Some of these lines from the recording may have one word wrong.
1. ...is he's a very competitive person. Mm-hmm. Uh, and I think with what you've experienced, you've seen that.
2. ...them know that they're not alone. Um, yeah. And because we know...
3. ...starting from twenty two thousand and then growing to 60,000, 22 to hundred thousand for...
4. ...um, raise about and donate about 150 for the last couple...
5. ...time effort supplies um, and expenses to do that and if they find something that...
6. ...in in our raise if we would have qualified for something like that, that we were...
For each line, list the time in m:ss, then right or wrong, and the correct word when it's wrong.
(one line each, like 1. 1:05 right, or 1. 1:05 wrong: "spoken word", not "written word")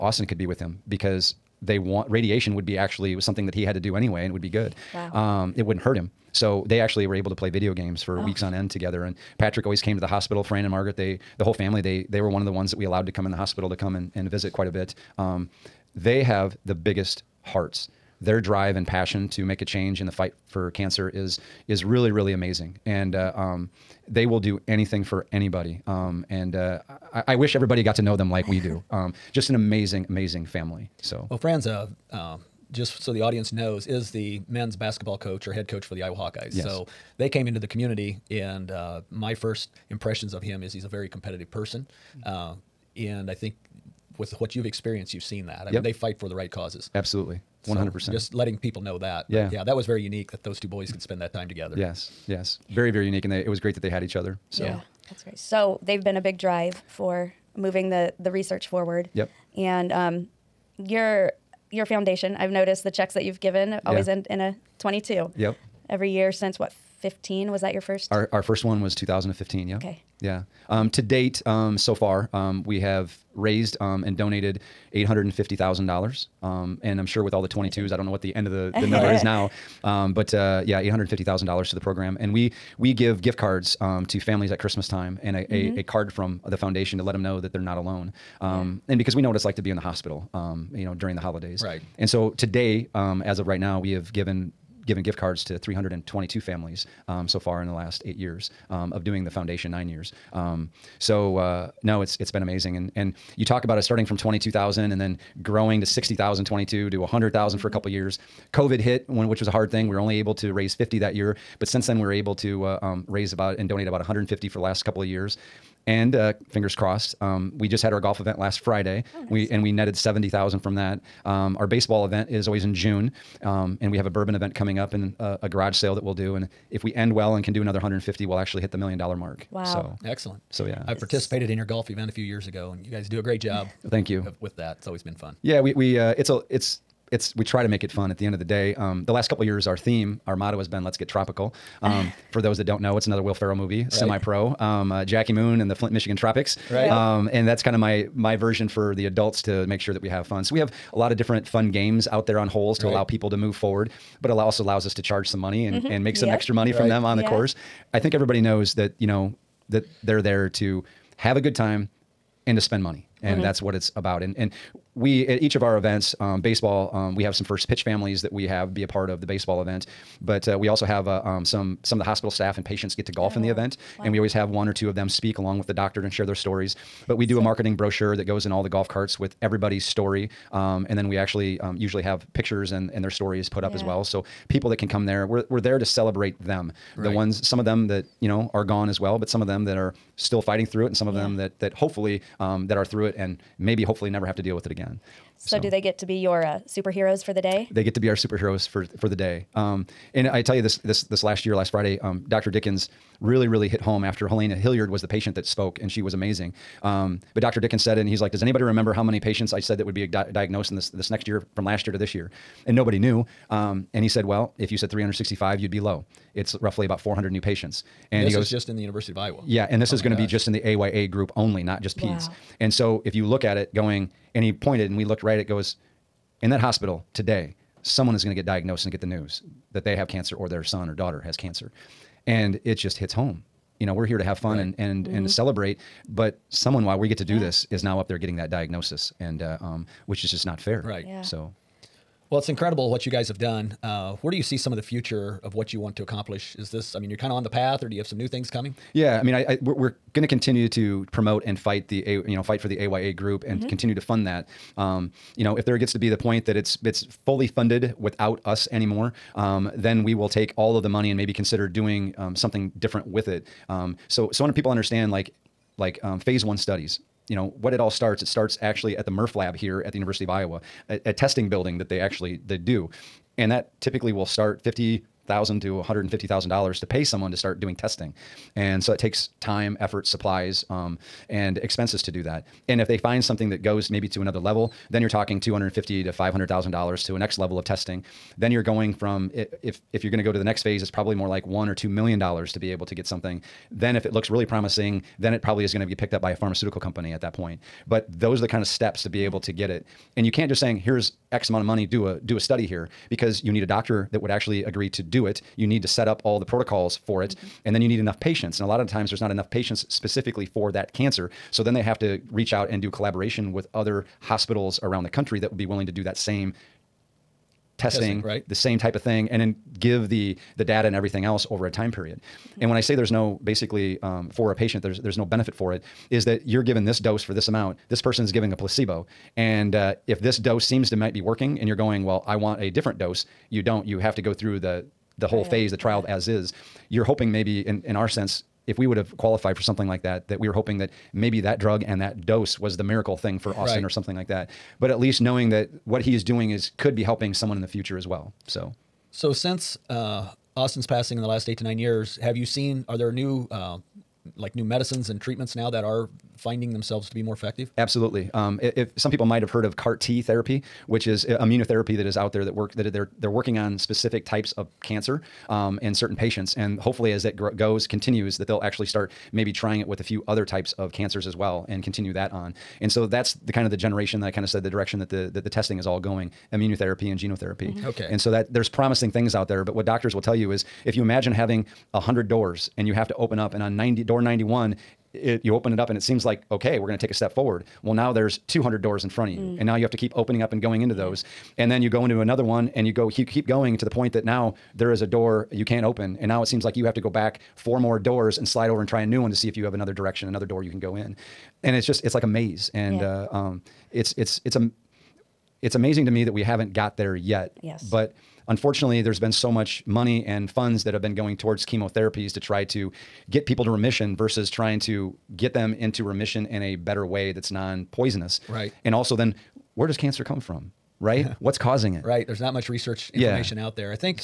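1. 0:40 right
2. 1:27 right
3. 1:43 right
4. 1:52 right
5. 4:39 right
6. 5:37 wrong: "sense", not "raise".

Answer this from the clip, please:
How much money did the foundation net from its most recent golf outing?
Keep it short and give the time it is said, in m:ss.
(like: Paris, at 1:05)
$70,000, at 1:59.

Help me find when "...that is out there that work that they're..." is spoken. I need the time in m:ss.
6:01.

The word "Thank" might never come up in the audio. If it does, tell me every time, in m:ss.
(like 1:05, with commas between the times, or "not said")
2:13.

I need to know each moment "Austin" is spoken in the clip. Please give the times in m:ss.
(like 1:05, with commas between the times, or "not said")
0:00, 5:43, 5:50.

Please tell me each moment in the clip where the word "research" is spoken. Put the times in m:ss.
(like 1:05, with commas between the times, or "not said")
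0:58, 7:02.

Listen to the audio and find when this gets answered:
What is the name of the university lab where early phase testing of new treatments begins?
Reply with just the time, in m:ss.
4:29.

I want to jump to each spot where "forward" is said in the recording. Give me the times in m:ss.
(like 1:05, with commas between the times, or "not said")
0:58, 2:33, 6:27.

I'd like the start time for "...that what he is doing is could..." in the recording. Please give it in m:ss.
5:45.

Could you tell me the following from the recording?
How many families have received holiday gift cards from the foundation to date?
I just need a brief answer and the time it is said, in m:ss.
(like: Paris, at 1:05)
322, at 1:35.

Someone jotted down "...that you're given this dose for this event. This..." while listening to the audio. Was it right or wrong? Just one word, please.
wrong.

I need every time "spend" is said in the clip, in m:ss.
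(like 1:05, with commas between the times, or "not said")
0:50, 2:42.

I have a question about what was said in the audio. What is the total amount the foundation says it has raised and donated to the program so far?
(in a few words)
$850,000.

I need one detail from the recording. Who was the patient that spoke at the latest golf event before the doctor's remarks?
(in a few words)
Helena Hilliard.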